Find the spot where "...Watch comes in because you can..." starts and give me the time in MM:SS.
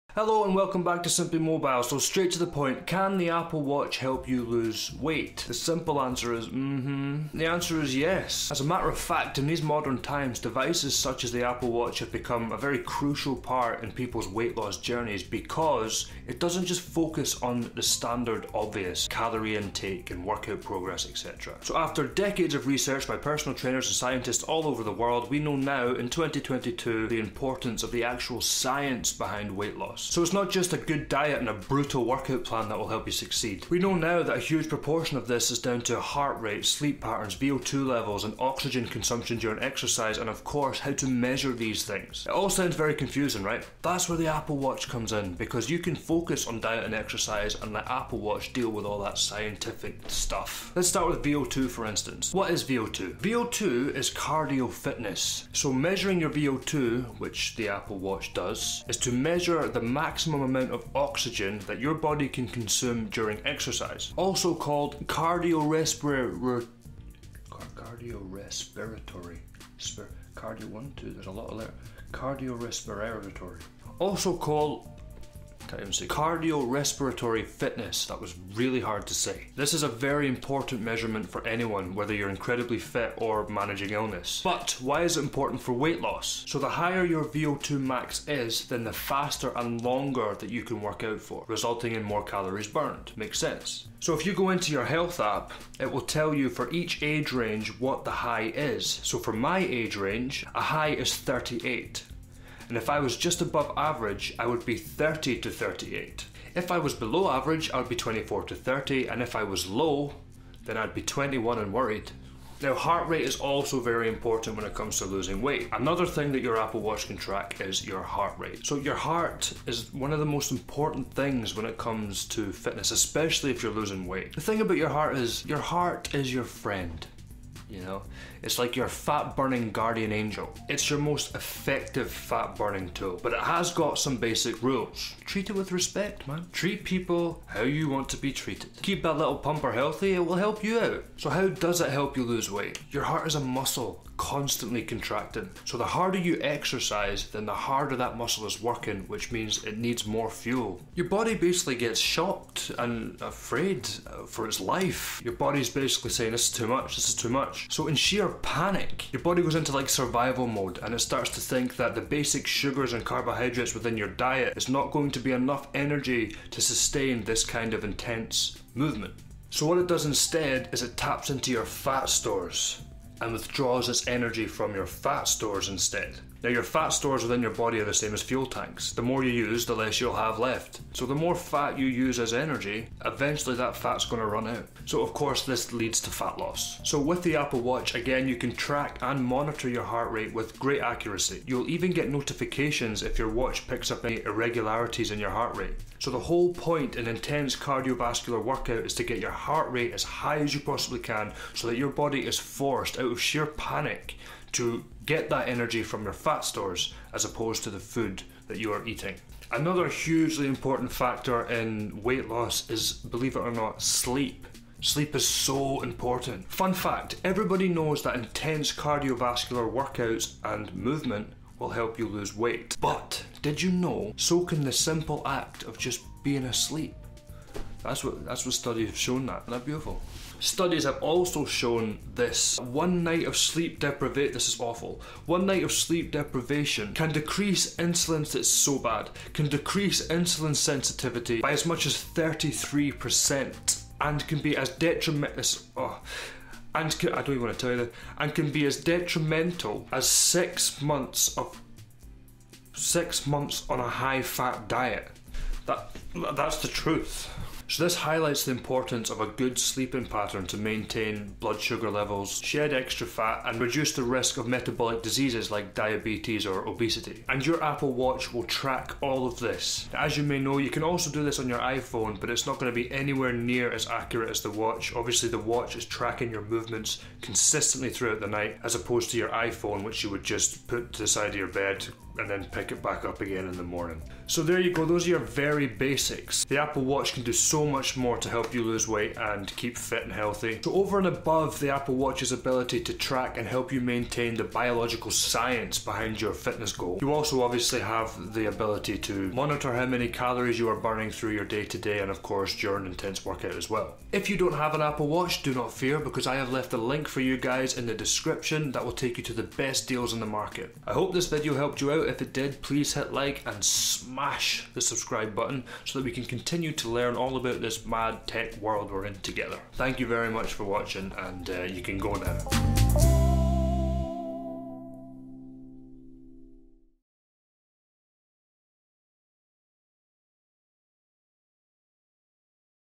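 00:44.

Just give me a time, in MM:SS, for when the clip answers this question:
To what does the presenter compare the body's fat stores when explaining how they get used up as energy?
02:58.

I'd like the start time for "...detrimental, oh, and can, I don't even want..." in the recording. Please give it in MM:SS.
04:04.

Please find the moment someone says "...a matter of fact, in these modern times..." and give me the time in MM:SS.
00:08.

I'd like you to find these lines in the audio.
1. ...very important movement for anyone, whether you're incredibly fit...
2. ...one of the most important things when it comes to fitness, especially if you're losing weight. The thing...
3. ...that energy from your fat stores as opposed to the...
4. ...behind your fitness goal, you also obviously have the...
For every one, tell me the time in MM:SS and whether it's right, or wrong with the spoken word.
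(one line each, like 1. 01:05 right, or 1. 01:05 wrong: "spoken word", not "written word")
1. 01:19 wrong: "measurement", not "movement"
2. 01:59 right
3. 03:25 right
4. 04:55 right.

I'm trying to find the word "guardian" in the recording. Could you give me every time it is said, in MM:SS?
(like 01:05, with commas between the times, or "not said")
02:09.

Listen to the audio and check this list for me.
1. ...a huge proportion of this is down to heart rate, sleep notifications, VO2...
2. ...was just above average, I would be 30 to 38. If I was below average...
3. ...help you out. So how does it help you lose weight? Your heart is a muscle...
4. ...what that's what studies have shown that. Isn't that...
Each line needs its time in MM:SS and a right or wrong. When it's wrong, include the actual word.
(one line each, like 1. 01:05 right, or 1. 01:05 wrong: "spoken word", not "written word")
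1. 00:34 wrong: "patterns", not "notifications"
2. 01:43 right
3. 02:20 right
4. 03:48 right.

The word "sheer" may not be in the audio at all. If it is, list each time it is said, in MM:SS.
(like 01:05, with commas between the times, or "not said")
02:37, 03:23.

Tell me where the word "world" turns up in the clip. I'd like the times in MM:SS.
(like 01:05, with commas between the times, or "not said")
00:24, 05:18.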